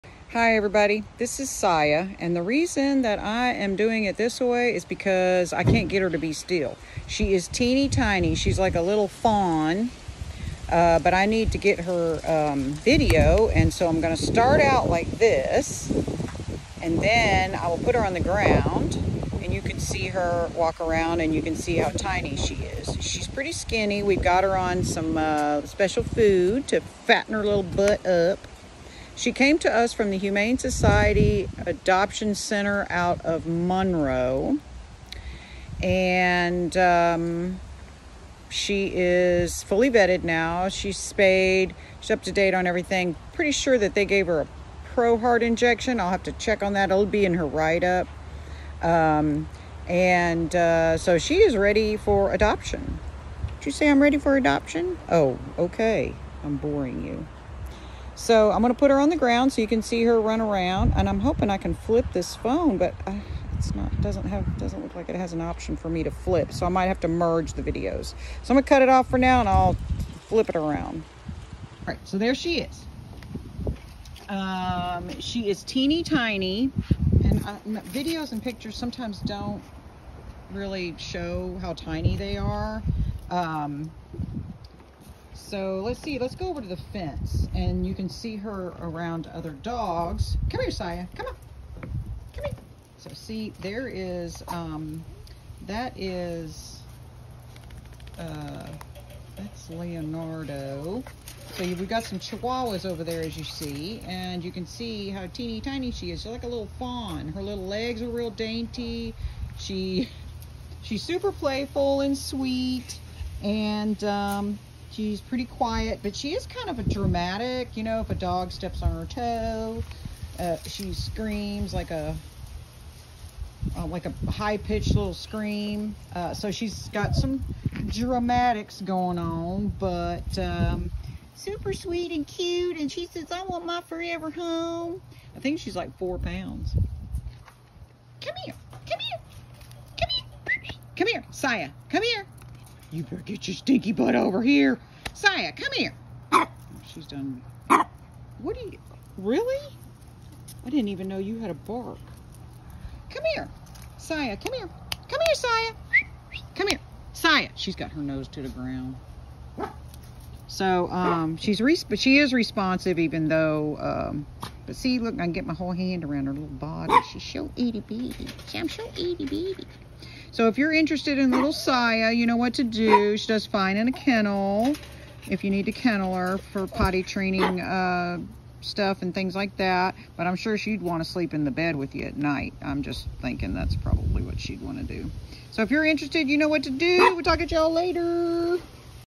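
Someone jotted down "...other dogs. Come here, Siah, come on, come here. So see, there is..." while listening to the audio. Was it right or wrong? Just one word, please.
right.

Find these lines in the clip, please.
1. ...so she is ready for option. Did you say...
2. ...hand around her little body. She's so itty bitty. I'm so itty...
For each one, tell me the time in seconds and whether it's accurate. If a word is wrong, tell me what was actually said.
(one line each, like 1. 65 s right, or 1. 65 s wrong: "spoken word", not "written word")
1. 50 s wrong: "adoption", not "option"
2. 165 s right.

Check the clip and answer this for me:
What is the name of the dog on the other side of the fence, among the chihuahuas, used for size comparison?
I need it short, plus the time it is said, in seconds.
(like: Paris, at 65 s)
Leonardo, at 99 s.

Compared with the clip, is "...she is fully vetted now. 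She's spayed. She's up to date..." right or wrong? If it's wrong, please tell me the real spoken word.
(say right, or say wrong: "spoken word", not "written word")
right.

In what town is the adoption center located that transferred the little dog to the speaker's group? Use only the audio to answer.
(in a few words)
Monroe.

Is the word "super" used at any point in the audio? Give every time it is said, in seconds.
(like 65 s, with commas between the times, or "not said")
111 s, 131 s.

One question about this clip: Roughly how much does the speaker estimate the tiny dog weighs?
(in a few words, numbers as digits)
4 pounds.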